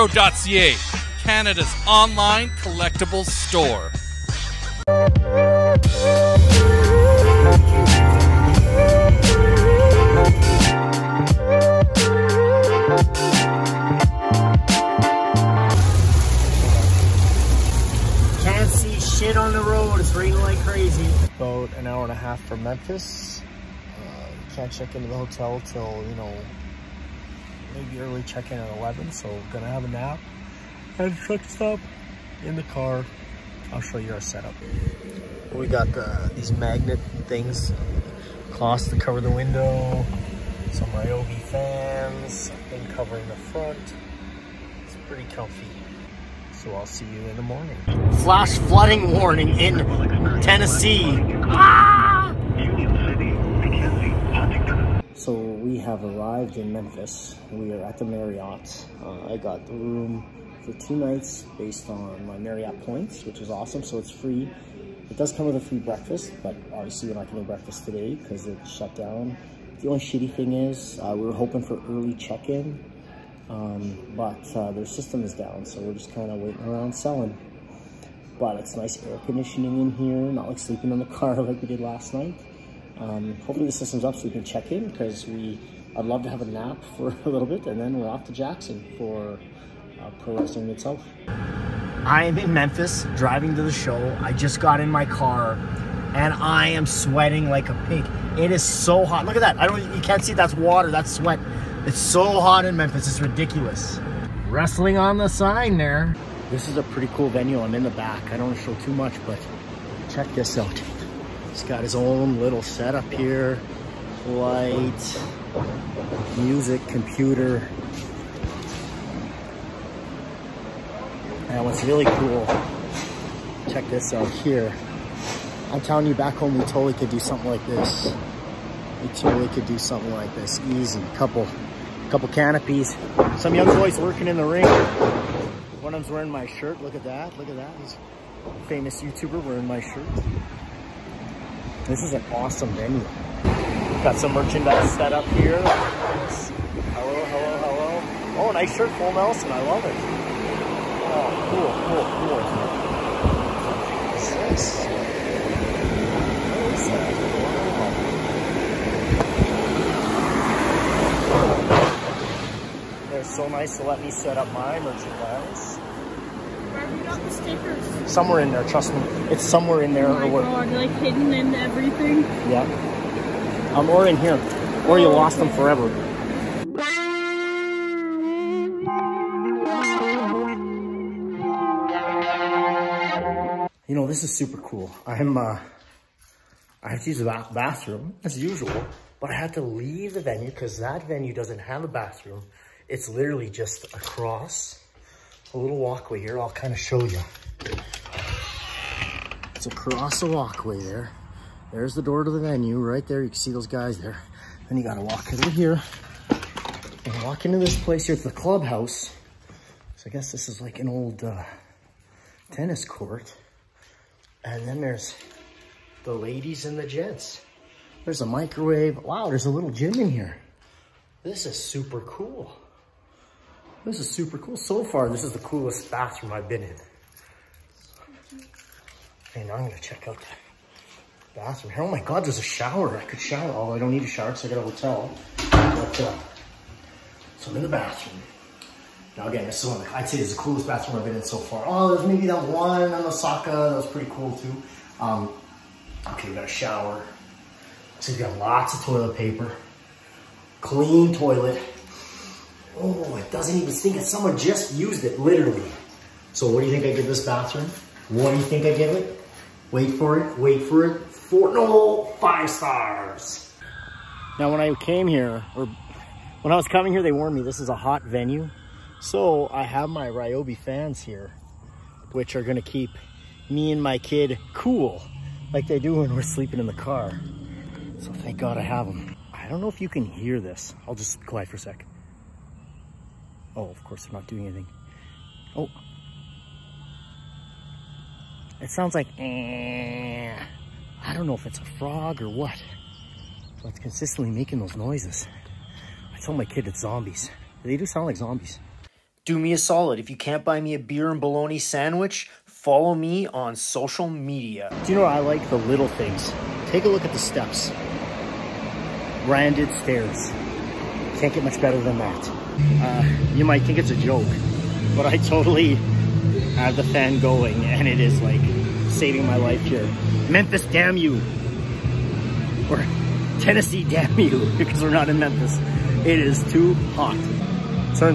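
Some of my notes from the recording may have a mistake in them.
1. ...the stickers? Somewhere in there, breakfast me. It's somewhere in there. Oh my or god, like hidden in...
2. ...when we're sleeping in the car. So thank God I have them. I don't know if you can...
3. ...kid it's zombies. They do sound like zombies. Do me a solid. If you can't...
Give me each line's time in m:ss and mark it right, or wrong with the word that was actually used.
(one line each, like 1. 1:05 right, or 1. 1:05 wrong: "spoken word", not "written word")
1. 2:47 wrong: "trust", not "breakfast"
2. 4:35 right
3. 4:56 right.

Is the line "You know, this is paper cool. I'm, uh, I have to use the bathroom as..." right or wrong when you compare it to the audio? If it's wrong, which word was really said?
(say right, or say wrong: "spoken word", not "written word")
wrong: "super", not "paper".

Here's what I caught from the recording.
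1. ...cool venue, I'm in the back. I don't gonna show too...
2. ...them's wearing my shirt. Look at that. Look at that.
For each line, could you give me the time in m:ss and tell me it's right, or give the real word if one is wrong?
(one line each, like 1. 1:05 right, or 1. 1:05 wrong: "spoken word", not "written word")
1. 1:47 wrong: "wanna", not "gonna"
2. 2:16 right.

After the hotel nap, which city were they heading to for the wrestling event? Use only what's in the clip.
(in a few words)
Jackson.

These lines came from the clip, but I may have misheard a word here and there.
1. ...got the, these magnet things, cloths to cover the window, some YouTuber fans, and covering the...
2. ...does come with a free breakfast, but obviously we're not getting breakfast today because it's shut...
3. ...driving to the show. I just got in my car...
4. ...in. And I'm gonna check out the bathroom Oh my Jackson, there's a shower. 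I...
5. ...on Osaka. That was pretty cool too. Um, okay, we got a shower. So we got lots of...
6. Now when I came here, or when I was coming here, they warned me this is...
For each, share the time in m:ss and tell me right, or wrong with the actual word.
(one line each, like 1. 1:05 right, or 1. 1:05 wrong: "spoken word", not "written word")
1. 0:35 wrong: "Ryobi", not "YouTuber"
2. 1:05 right
3. 1:33 right
4. 3:46 wrong: "God", not "Jackson"
5. 4:02 right
6. 4:24 right.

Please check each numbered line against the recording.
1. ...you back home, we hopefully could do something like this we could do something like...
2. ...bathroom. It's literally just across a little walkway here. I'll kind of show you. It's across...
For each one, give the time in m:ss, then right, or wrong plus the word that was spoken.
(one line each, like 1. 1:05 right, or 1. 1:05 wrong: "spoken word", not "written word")
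1. 2:06 wrong: "totally", not "hopefully"
2. 3:11 right.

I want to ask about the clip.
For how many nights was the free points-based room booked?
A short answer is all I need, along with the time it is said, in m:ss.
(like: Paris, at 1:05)
2, at 1:00.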